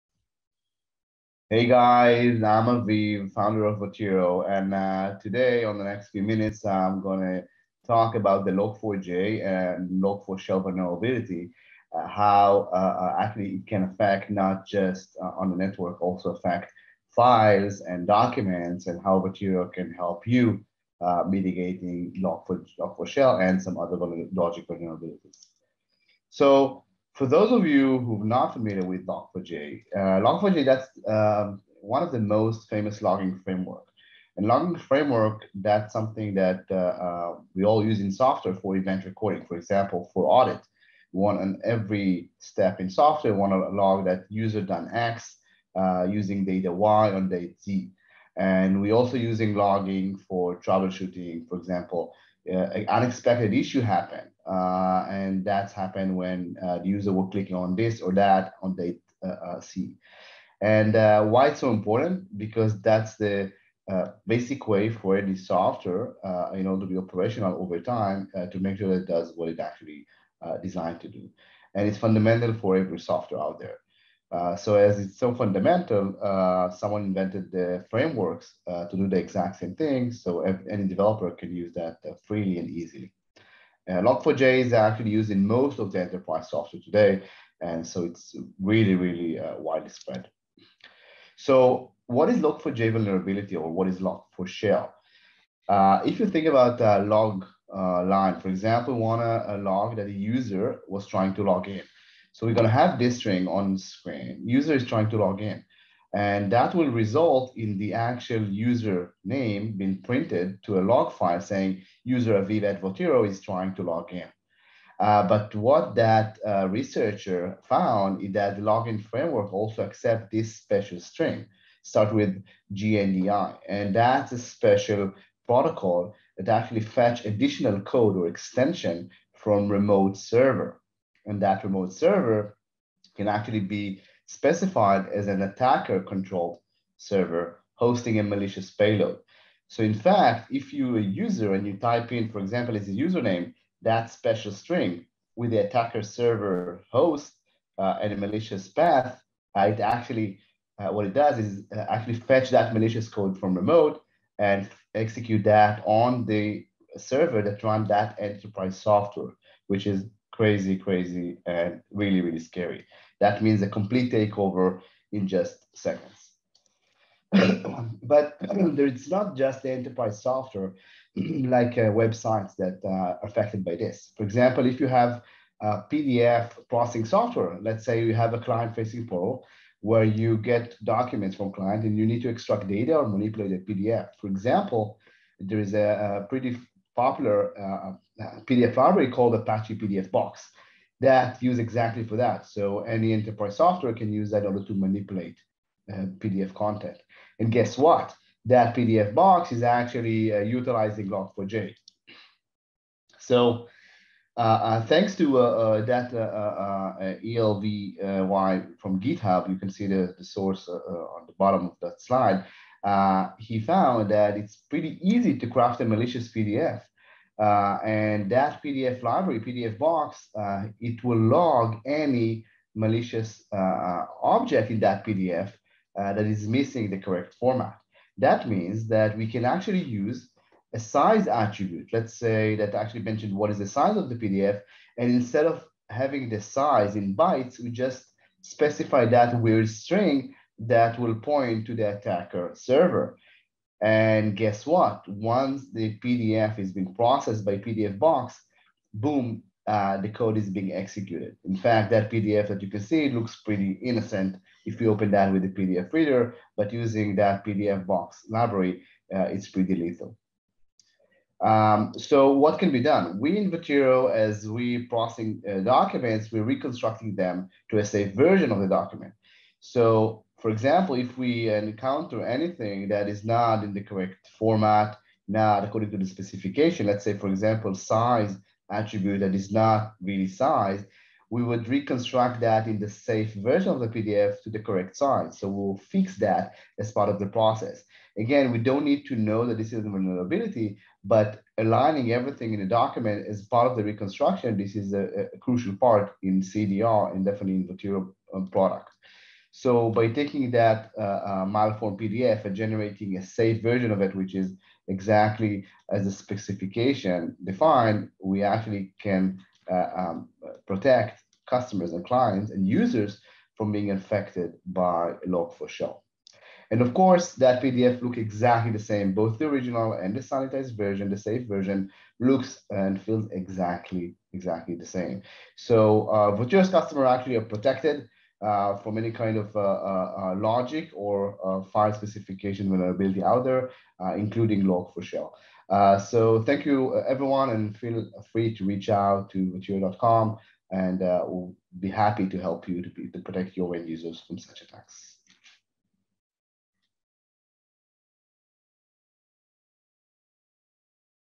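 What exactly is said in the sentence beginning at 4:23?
We in Votiro, as we processing uh, documents, we're reconstructing them to a safe version of the document.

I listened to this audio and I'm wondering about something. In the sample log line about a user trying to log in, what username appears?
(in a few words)
Aviv Advotiro.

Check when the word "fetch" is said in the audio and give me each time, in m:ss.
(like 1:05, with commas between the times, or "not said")
2:06, 2:32.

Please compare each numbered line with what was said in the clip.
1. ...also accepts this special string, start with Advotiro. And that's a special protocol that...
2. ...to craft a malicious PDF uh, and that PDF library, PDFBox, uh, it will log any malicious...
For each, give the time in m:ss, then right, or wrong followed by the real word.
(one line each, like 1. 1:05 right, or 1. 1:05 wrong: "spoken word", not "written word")
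1. 1:59 wrong: "JNDI", not "Advotiro"
2. 3:35 right.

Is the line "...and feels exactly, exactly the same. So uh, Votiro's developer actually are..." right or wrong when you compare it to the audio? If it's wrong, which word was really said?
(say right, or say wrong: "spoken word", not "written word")
wrong: "customer", not "developer".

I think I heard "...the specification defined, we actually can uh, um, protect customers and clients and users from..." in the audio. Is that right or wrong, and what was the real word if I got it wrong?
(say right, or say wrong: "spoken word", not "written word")
right.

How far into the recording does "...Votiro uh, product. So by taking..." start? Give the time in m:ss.
4:57.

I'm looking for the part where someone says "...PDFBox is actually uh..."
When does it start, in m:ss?
3:18.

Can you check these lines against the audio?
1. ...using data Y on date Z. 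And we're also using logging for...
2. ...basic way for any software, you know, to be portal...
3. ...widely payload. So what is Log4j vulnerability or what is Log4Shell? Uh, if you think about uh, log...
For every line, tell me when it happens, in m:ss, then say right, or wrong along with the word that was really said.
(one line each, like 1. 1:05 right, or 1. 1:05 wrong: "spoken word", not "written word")
1. 0:46 right
2. 1:04 wrong: "operational", not "portal"
3. 1:29 wrong: "spread", not "payload".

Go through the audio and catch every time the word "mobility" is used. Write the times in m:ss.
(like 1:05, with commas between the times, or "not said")
not said.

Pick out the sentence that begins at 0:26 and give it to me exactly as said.
So for those of you who are not familiar with Log4j, uh, Log4j that's um, one of the most famous logging framework.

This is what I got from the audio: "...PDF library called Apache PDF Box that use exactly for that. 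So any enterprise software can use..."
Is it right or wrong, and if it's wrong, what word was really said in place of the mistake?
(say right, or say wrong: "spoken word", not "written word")
right.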